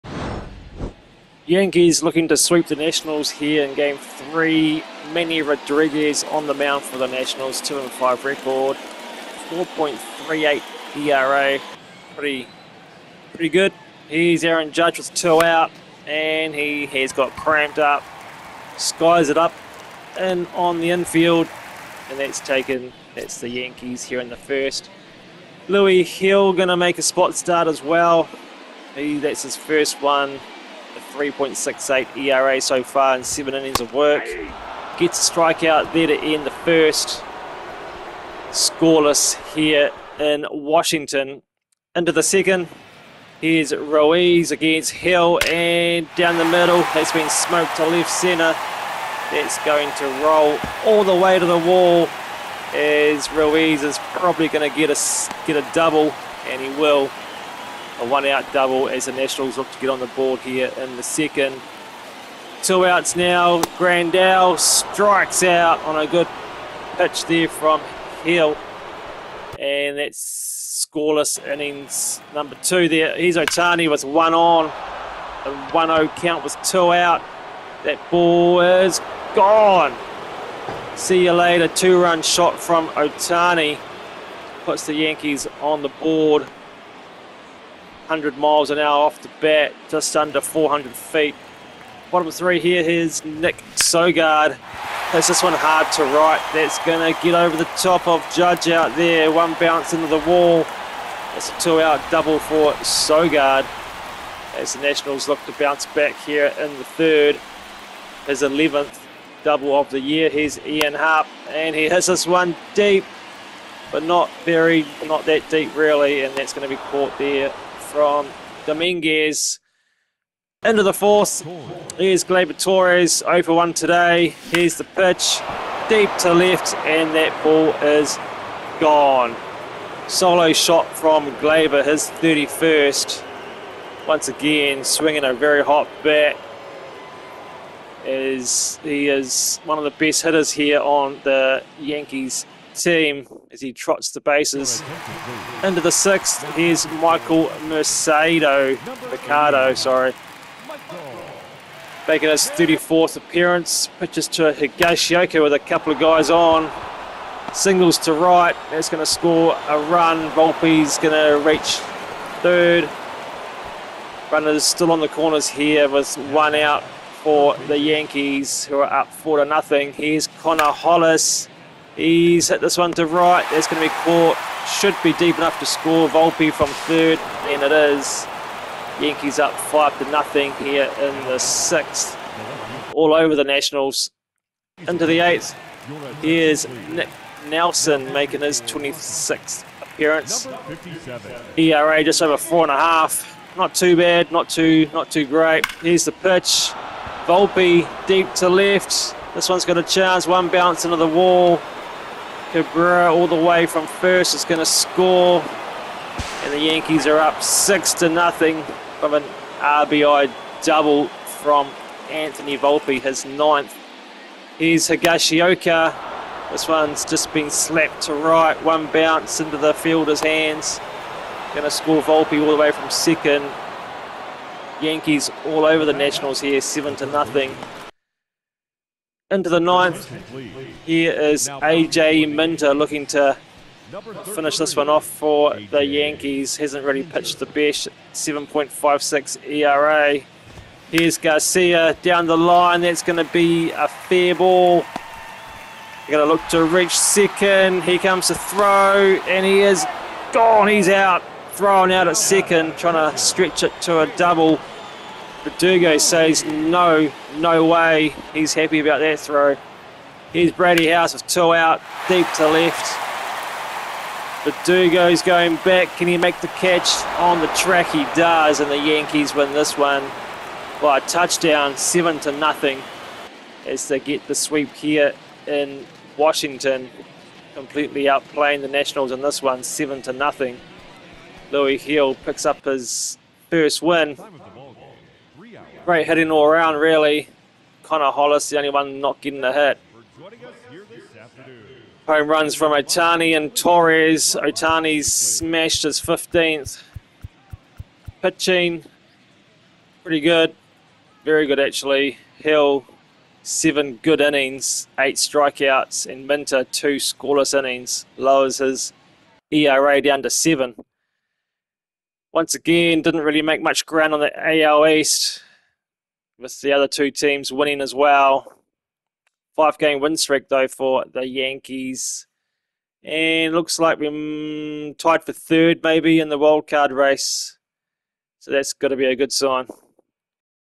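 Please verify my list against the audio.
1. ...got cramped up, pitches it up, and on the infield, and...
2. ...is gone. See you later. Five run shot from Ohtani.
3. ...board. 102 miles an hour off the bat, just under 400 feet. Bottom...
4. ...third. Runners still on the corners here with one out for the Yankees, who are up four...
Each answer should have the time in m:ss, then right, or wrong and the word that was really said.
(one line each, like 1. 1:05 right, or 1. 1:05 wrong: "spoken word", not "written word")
1. 0:17 wrong: "skies", not "pitches"
2. 1:18 wrong: "Two", not "Five"
3. 1:26 wrong: "100", not "102"
4. 2:42 right.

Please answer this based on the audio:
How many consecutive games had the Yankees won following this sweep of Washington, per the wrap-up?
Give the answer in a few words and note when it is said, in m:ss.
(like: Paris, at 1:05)
5, at 5:19.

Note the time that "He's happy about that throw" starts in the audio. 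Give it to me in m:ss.
4:18.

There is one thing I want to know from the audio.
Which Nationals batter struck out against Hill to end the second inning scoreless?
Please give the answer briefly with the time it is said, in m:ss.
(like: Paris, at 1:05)
Grandal, at 1:03.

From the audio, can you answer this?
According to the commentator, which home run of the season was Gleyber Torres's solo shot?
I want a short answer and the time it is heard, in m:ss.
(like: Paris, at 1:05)
31st, at 2:11.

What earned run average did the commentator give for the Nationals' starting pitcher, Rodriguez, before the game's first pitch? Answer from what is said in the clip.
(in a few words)
4.38.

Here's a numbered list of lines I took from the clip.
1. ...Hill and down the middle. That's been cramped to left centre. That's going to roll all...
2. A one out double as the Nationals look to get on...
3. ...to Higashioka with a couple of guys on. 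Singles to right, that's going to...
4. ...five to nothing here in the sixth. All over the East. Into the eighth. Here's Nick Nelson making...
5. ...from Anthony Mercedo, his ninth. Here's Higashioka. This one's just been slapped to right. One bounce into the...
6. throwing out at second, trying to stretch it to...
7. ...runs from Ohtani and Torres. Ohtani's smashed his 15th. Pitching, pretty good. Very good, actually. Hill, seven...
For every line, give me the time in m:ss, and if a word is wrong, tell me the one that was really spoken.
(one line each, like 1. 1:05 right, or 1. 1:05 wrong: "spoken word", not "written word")
1. 0:44 wrong: "smoked", not "cramped"
2. 0:58 right
3. 2:34 right
4. 2:59 wrong: "Nationals", not "East"
5. 3:31 wrong: "Volpe", not "Mercedo"
6. 4:11 right
7. 4:52 right.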